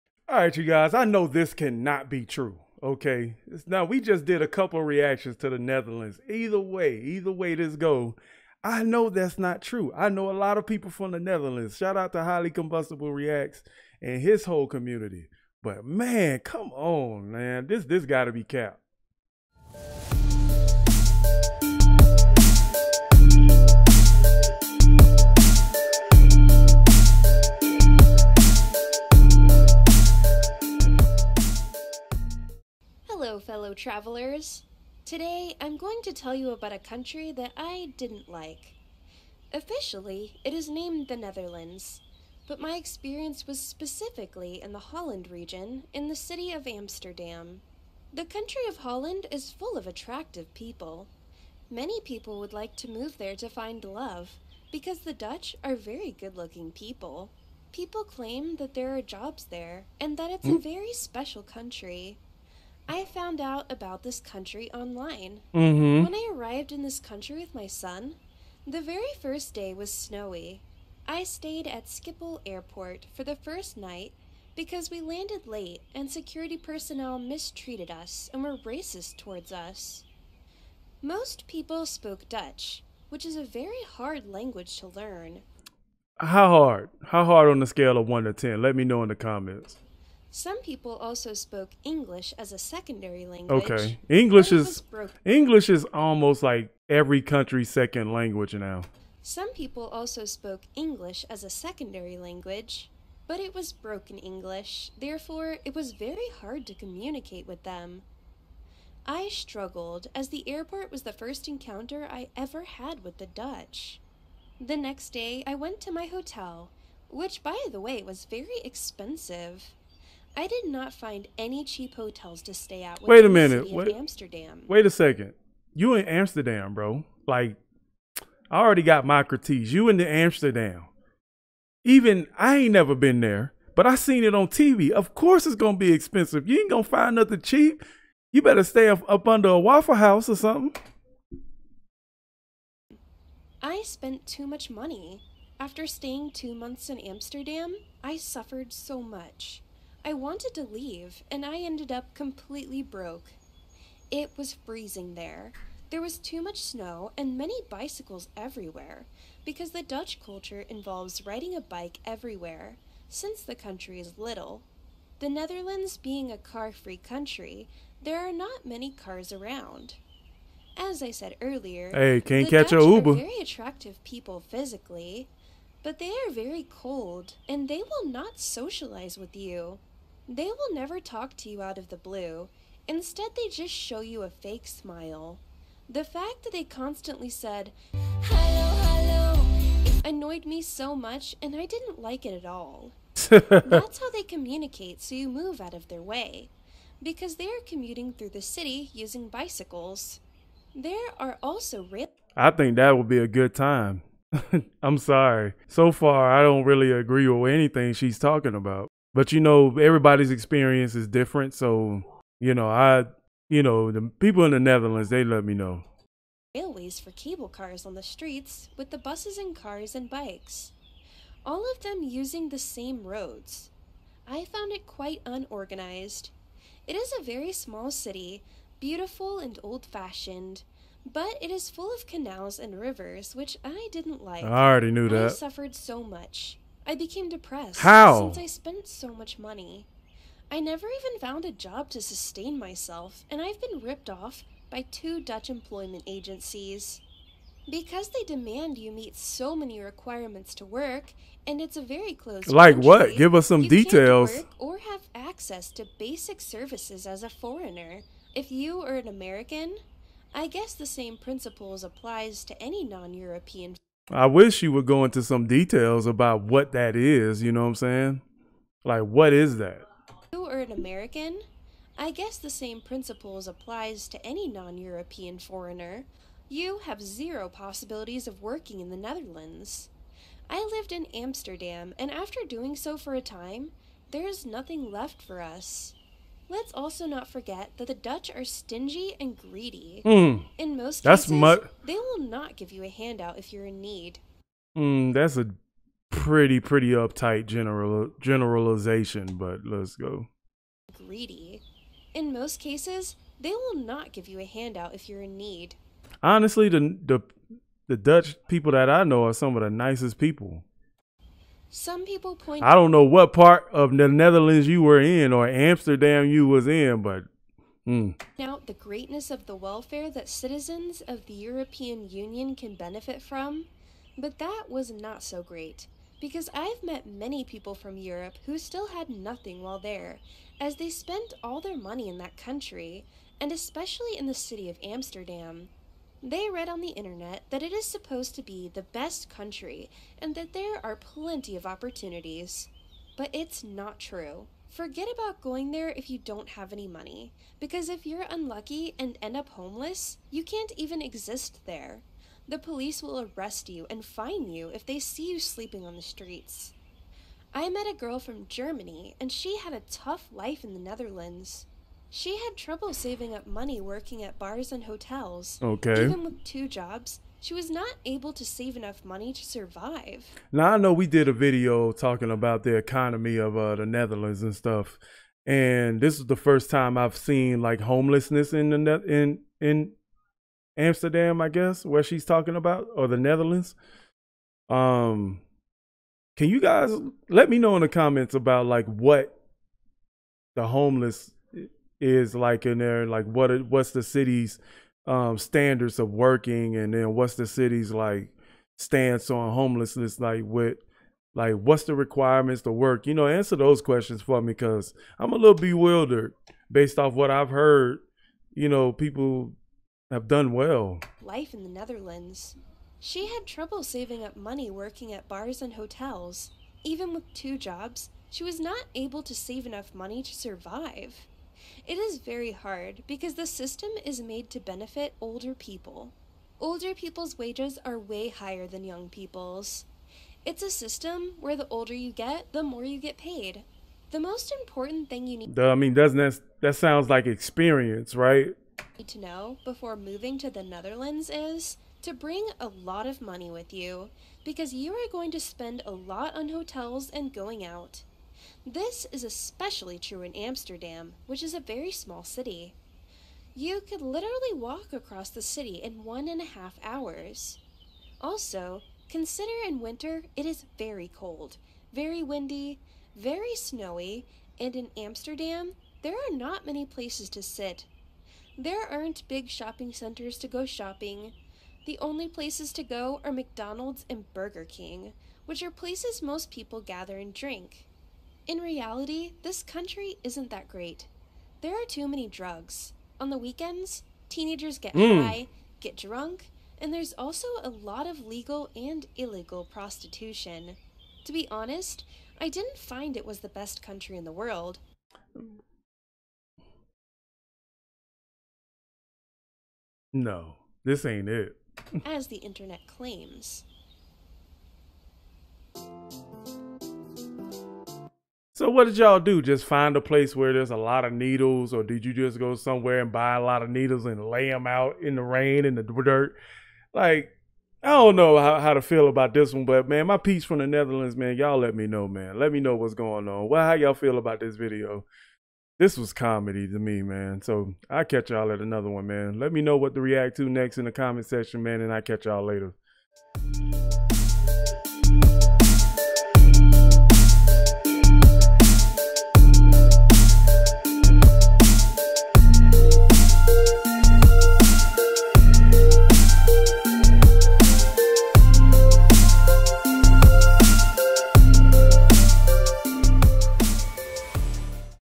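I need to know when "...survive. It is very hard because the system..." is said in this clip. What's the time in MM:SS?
07:00.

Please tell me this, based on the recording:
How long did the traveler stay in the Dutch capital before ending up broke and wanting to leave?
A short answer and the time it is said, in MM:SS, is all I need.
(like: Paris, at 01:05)
Two months, at 02:26.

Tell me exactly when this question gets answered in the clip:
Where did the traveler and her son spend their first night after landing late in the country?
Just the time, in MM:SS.
01:11.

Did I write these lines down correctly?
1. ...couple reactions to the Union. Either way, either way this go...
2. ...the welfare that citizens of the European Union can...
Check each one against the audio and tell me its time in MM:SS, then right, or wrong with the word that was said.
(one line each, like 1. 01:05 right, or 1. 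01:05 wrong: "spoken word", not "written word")
1. 00:04 wrong: "Netherlands", not "Union"
2. 05:19 right.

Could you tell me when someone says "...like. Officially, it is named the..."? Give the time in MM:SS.
00:38.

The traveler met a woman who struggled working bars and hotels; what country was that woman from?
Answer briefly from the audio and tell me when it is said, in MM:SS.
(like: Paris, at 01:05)
Germany, at 05:58.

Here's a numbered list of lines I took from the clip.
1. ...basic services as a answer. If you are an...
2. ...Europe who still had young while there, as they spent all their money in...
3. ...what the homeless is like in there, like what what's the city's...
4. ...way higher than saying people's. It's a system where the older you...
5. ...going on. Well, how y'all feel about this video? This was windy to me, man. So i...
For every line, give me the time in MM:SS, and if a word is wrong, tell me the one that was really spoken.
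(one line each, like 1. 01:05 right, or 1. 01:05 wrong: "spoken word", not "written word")
1. 04:15 wrong: "foreigner", not "answer"
2. 05:27 wrong: "nothing", not "young"
3. 06:28 right
4. 07:07 wrong: "young", not "saying"
5. 08:42 wrong: "comedy", not "windy".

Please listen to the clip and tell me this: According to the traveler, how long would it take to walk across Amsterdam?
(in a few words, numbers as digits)
One and a half hours.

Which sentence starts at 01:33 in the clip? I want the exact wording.
Okay, English is English is almost like every country's second language now.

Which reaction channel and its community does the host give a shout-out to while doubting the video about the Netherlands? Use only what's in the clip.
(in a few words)
Highly Combustible Reacts.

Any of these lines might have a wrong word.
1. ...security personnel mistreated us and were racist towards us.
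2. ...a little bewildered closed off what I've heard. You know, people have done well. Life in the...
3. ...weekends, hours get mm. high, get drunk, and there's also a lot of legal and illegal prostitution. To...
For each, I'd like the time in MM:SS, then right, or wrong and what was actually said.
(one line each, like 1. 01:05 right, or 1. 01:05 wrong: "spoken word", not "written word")
1. 01:16 right
2. 06:45 wrong: "based", not "closed"
3. 08:03 wrong: "teenagers", not "hours".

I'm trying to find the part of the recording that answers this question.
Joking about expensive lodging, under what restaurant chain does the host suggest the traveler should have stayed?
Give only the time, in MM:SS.
02:19.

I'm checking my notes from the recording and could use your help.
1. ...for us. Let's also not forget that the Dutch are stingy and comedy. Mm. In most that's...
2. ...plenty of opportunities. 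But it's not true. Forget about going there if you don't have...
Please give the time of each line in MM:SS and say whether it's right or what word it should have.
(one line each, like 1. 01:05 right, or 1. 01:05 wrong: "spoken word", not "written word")
1. 04:45 wrong: "greedy", not "comedy"
2. 05:40 right.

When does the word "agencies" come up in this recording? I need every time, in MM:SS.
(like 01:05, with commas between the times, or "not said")
04:06.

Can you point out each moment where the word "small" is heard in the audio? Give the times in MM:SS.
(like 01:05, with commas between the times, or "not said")
03:47, 07:31.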